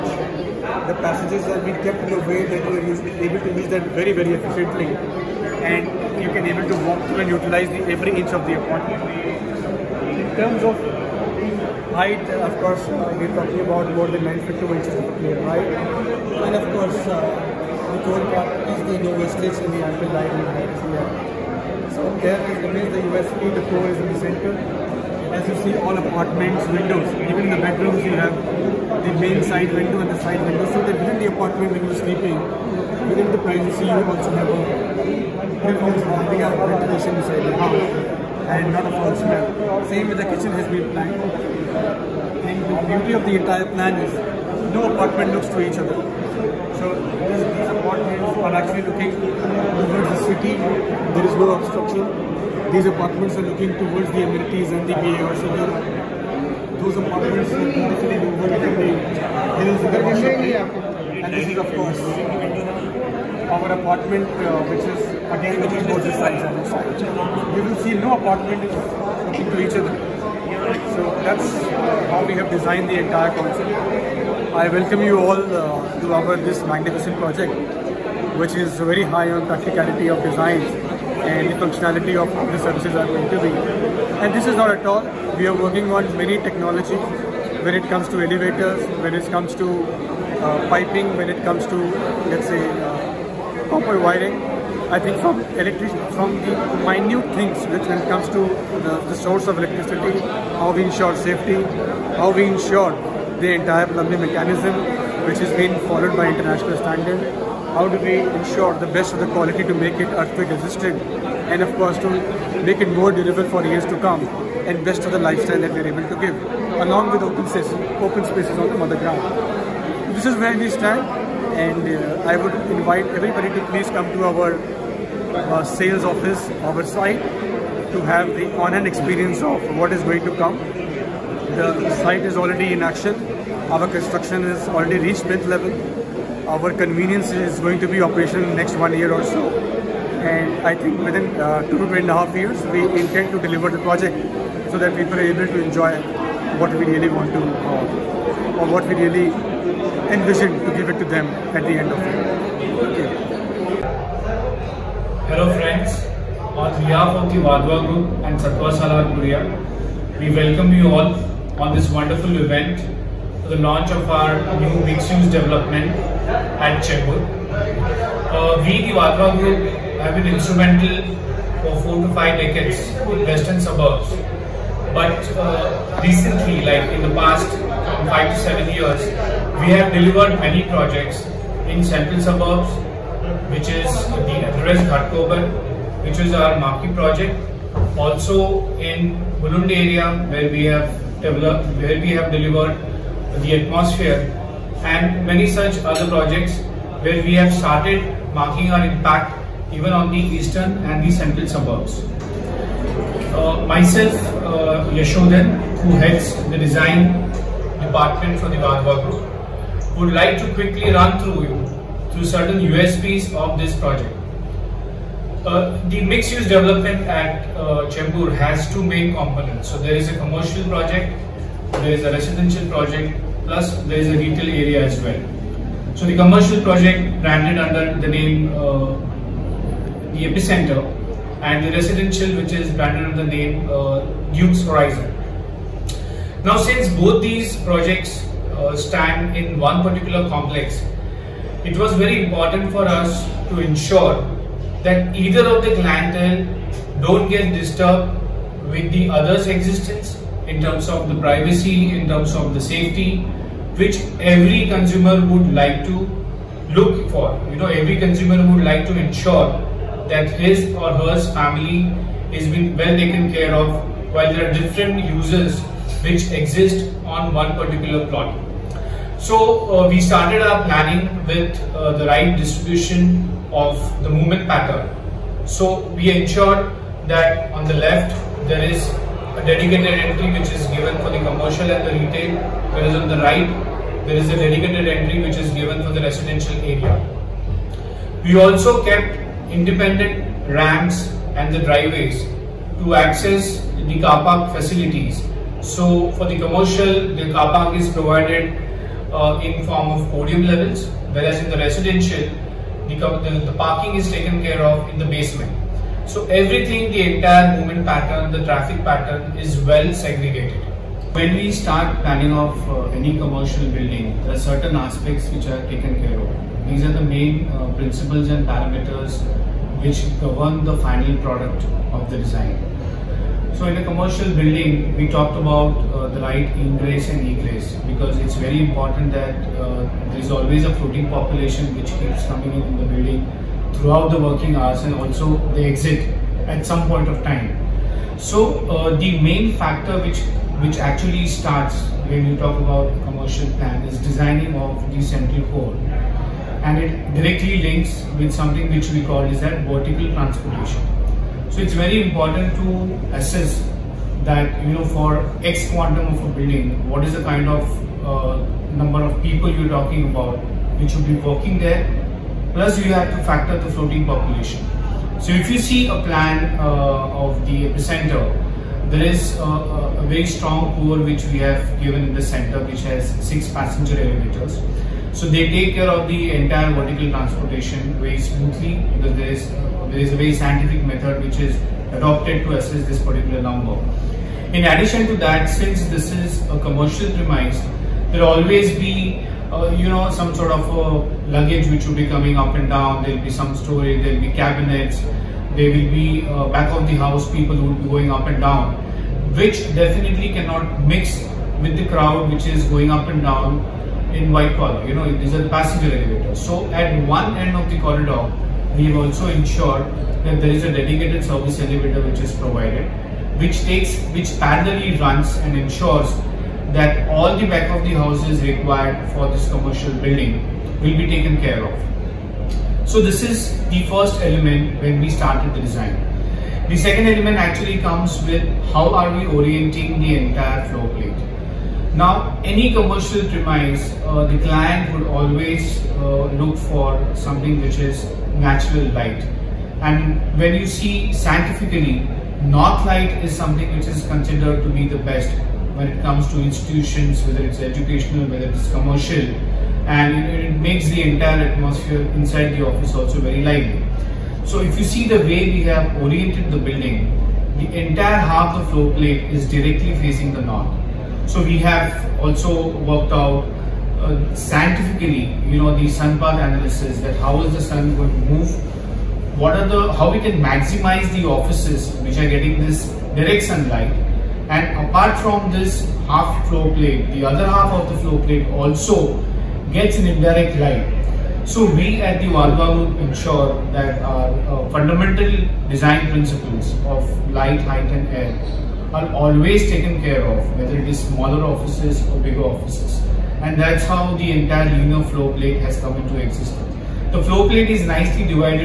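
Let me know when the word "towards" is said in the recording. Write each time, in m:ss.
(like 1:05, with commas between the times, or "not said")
0:49, 0:53.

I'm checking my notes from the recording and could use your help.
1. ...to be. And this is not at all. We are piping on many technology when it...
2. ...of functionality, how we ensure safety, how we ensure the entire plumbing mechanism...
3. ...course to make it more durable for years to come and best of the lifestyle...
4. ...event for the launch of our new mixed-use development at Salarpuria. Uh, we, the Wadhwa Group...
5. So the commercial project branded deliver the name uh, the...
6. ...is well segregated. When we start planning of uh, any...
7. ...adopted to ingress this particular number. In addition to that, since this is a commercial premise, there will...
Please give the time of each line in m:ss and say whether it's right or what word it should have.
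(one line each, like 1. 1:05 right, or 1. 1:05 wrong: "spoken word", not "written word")
1. 1:23 wrong: "working", not "piping"
2. 1:39 wrong: "electricity", not "functionality"
3. 1:51 right
4. 2:42 wrong: "Chembur", not "Salarpuria"
5. 3:45 wrong: "under", not "deliver"
6. 5:09 right
7. 6:21 wrong: "assess", not "ingress".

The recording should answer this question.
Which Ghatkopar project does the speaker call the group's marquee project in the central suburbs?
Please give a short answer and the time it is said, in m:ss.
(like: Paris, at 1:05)
The Everest, at 3:04.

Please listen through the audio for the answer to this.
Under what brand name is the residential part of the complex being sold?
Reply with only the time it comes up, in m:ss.
3:54.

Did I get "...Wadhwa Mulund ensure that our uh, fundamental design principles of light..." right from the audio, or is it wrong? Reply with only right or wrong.
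wrong.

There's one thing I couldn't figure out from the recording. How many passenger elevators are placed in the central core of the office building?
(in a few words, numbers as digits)
6.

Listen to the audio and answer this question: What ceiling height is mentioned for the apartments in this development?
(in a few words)
9 feet 2 inches.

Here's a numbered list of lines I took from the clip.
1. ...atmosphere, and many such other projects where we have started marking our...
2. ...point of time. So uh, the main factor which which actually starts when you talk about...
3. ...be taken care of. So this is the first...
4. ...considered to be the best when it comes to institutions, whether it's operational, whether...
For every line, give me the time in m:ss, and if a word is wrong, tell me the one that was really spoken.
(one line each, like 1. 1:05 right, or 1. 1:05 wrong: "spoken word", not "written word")
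1. 3:13 right
2. 5:36 right
3. 7:00 right
4. 7:24 wrong: "educational", not "operational".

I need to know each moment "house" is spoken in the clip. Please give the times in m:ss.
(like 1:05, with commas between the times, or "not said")
0:37, 6:36, 6:57.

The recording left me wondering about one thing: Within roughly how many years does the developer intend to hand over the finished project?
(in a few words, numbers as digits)
2 to 2.5 years.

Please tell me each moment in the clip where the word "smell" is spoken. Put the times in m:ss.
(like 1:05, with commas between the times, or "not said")
0:39.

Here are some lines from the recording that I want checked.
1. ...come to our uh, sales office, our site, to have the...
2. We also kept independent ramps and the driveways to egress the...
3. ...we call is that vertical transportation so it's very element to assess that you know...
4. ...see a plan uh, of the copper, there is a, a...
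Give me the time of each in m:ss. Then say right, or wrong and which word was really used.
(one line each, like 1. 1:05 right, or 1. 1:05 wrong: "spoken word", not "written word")
1. 2:03 right
2. 4:48 wrong: "access", not "egress"
3. 5:48 wrong: "important", not "element"
4. 6:05 wrong: "epicenter", not "copper".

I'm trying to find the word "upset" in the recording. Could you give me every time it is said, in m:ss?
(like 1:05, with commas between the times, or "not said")
not said.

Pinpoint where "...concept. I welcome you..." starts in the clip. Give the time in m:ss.
1:13.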